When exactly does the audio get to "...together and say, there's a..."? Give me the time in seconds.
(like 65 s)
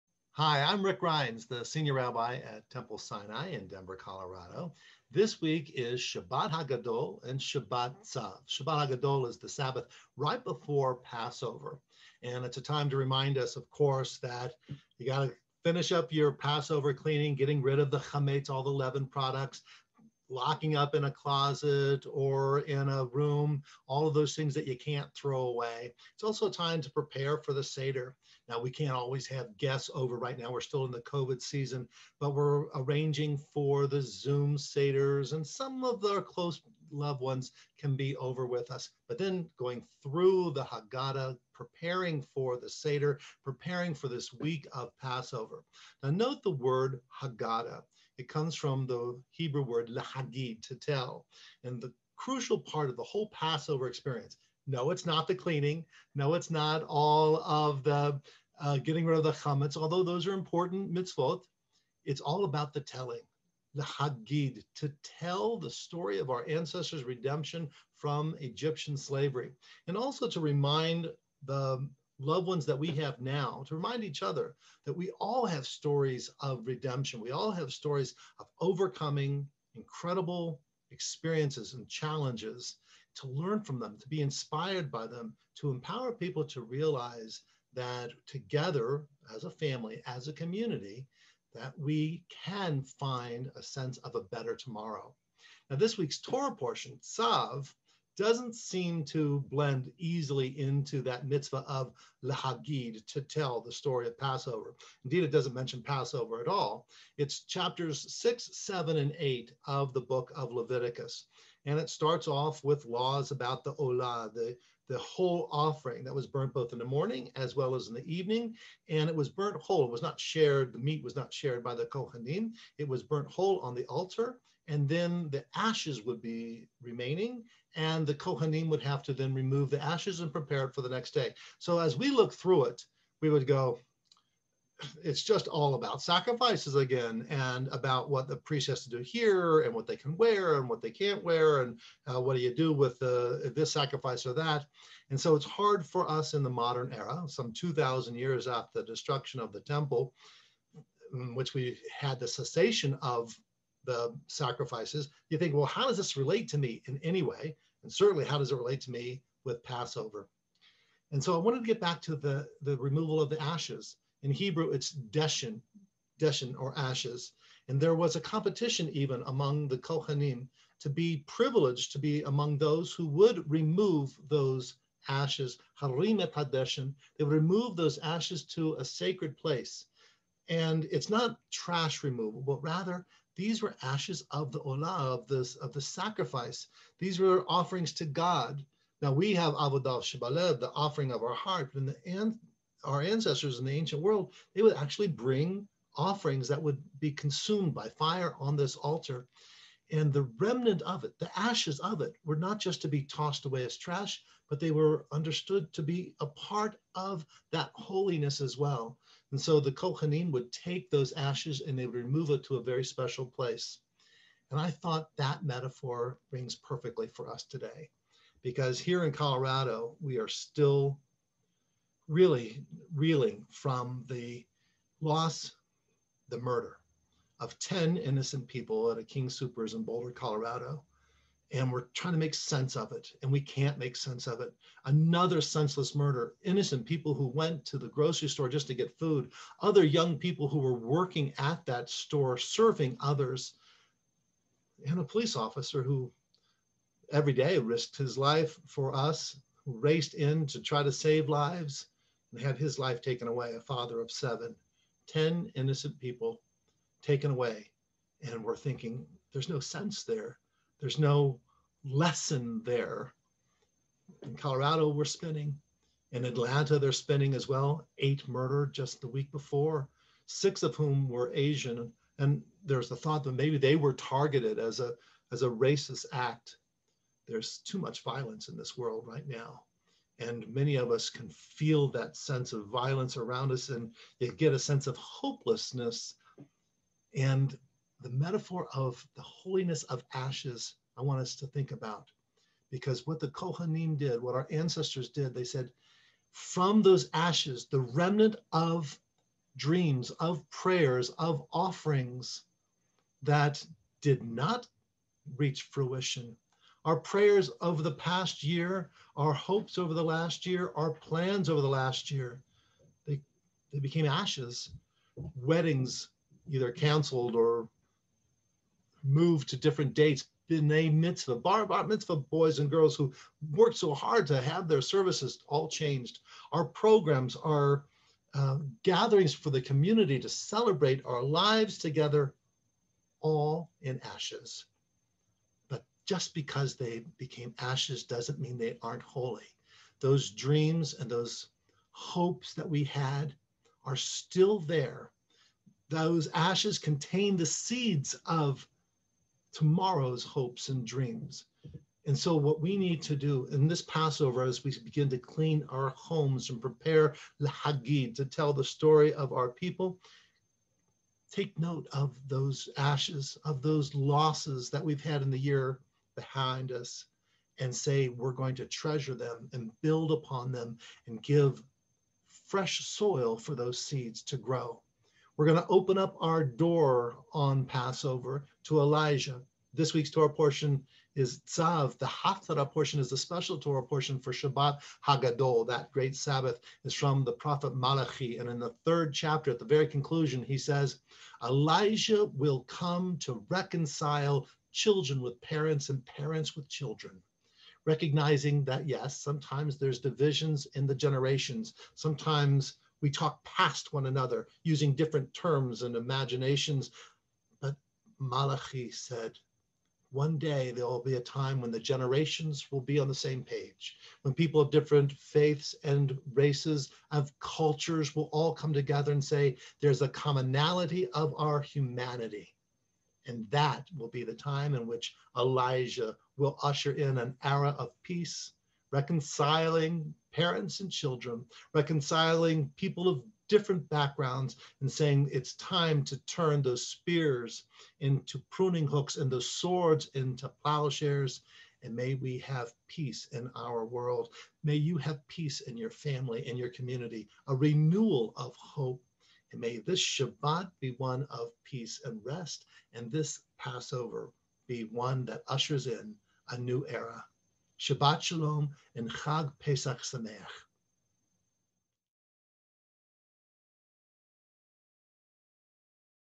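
418 s.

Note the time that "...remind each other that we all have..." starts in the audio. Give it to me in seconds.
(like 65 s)
73 s.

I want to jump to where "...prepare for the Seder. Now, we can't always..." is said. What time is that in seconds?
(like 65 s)
26 s.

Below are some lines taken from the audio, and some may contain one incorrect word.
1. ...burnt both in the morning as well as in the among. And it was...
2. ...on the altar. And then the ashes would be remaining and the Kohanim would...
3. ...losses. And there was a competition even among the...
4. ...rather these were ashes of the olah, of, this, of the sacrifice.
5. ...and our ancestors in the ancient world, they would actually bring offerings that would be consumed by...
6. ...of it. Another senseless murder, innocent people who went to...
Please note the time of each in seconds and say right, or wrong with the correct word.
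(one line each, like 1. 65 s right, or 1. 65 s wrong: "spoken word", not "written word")
1. 116 s wrong: "evening", not "among"
2. 123 s right
3. 166 s wrong: "ashes", not "losses"
4. 182 s right
5. 192 s right
6. 234 s right.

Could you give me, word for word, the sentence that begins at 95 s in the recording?
Now, this week's Torah portion, Tzav, doesn't seem to blend easily into that mitzvah of lahagid to tell the story of Passover.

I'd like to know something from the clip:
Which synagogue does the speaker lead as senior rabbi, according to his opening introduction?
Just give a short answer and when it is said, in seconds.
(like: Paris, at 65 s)
Temple Sinai, at 2 s.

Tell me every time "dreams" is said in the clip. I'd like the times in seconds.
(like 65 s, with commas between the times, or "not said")
299 s, 340 s, 350 s.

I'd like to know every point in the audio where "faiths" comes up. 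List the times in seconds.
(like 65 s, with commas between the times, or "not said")
415 s.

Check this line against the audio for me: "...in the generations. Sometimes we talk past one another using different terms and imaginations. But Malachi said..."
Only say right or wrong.
right.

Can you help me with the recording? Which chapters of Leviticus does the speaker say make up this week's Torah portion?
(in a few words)
6, 7, and 8.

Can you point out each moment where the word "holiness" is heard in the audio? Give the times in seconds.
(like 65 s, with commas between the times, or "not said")
207 s, 289 s.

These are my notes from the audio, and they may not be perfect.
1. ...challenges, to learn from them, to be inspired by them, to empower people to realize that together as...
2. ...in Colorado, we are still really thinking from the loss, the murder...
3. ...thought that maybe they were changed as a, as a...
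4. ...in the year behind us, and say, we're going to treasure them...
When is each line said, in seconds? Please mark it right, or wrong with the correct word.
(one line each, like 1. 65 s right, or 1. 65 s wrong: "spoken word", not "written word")
1. 81 s right
2. 219 s wrong: "reeling", not "thinking"
3. 272 s wrong: "targeted", not "changed"
4. 365 s right.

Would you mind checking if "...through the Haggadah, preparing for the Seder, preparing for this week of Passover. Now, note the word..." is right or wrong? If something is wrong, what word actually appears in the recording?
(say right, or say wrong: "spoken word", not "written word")
right.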